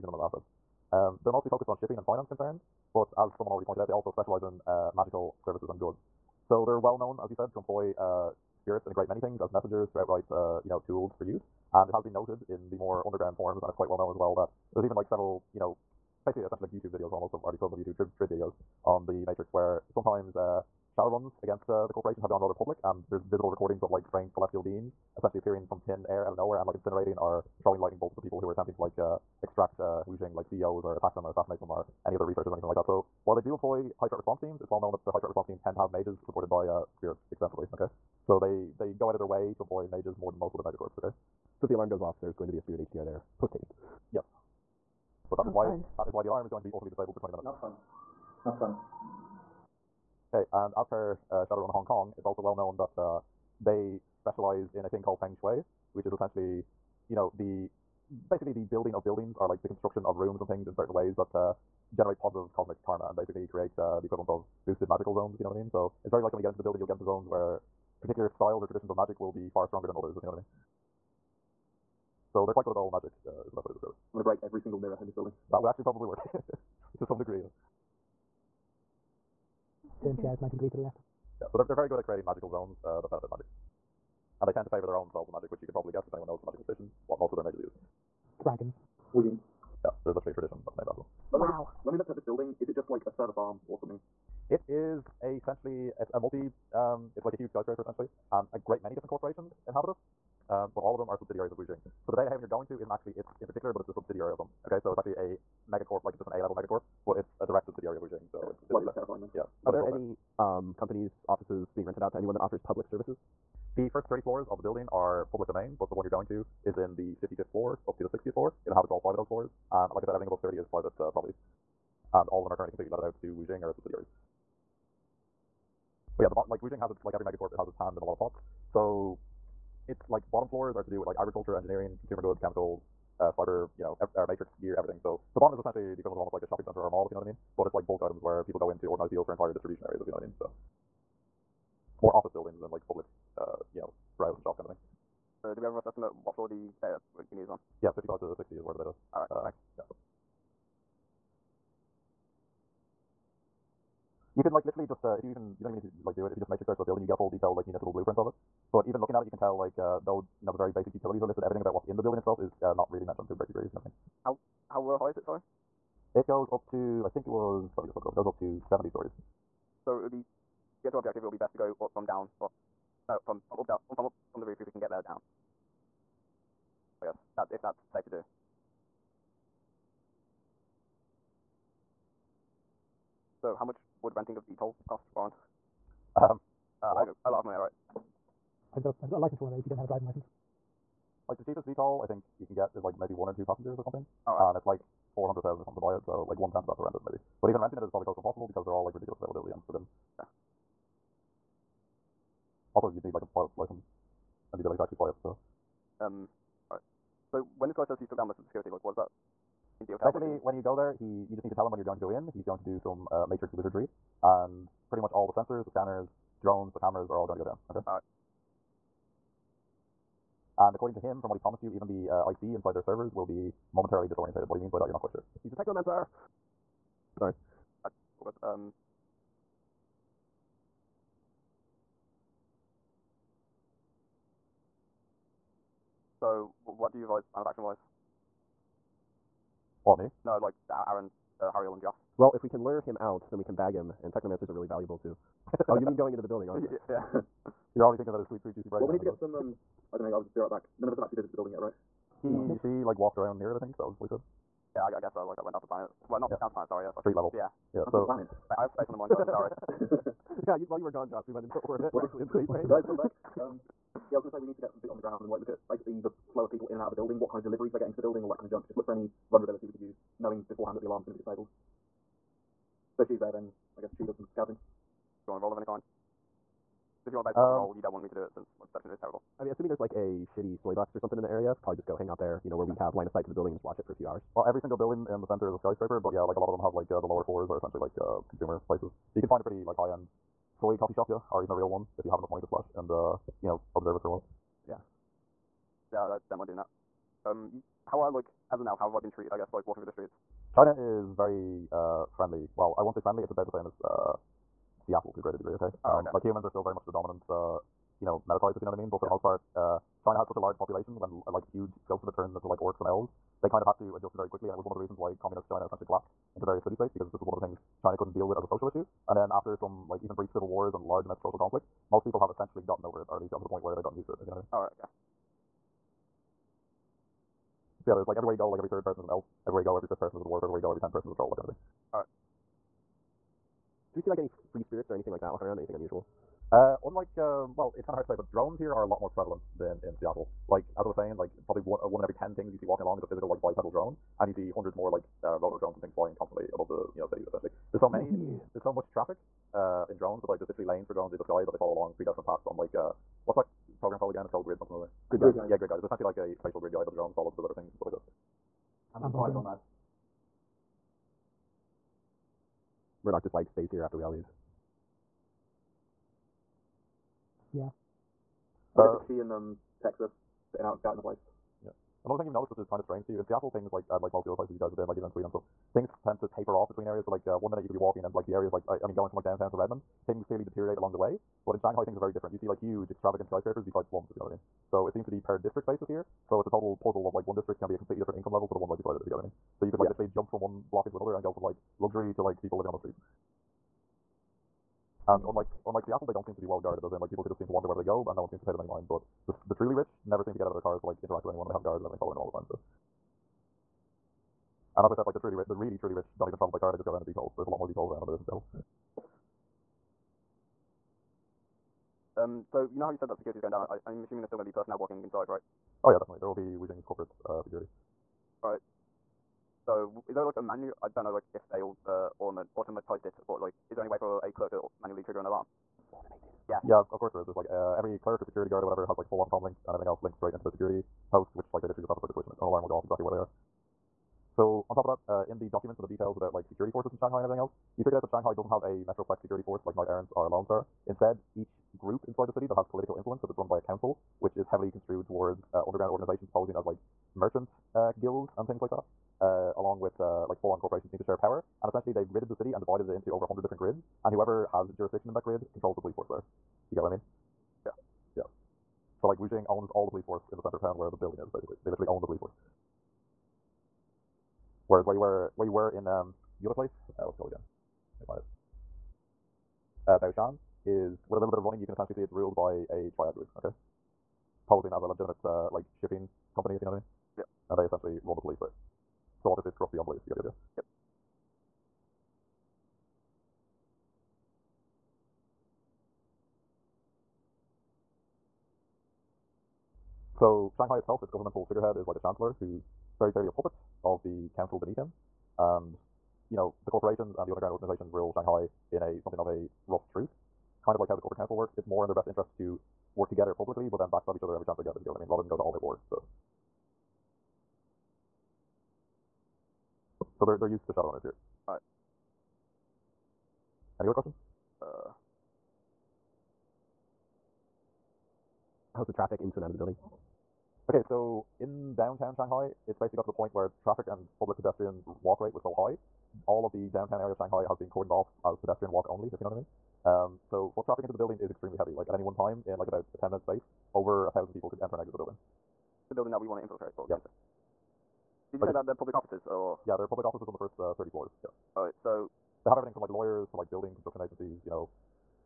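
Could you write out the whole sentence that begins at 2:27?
Yeah, 55 to 60 is where the data.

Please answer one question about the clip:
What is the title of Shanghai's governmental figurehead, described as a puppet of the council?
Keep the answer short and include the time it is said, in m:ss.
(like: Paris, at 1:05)
Chancellor, at 8:11.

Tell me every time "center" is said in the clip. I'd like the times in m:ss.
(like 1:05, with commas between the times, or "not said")
2:16, 4:45, 7:40.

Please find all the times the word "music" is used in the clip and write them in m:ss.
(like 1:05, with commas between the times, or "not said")
not said.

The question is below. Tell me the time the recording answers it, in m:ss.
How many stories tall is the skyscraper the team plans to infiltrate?
2:48.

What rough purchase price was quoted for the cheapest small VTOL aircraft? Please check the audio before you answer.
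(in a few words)
400,000.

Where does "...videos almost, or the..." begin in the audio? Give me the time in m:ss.
0:16.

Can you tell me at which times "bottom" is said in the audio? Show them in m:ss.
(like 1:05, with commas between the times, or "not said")
2:10, 2:15.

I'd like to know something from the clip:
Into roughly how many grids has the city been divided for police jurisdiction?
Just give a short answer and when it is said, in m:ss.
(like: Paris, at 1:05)
Over 100, at 7:33.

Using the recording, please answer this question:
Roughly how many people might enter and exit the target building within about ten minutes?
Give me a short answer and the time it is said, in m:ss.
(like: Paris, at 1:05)
Over 1,000, at 8:53.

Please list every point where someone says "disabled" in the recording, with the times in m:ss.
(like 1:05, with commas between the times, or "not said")
0:46, 4:31.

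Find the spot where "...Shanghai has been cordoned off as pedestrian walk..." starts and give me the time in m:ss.
8:47.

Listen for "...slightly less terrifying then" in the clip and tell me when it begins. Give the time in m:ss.
1:48.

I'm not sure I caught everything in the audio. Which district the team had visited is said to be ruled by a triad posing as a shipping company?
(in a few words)
Baoshan.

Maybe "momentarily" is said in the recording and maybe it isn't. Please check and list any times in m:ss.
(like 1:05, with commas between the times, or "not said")
3:43.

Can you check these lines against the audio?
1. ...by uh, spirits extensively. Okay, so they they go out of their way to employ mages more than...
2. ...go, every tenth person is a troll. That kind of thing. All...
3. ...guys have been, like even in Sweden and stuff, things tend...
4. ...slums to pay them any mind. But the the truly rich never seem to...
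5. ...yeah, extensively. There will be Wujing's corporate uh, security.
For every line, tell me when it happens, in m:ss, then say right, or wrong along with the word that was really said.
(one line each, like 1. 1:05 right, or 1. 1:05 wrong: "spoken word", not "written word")
1. 0:36 right
2. 5:30 right
3. 6:14 right
4. 6:38 wrong: "seems", not "slums"
5. 6:55 wrong: "definitely", not "extensively".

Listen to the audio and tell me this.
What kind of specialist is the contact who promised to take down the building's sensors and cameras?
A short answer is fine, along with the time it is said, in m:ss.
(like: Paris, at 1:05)
Technomancer, at 3:45.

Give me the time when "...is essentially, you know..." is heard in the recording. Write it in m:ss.
0:56.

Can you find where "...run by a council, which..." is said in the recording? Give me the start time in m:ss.
7:23.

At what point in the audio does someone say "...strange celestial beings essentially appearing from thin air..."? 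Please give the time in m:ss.
0:24.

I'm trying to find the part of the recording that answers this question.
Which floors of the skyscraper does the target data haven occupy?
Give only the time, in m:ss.
1:57.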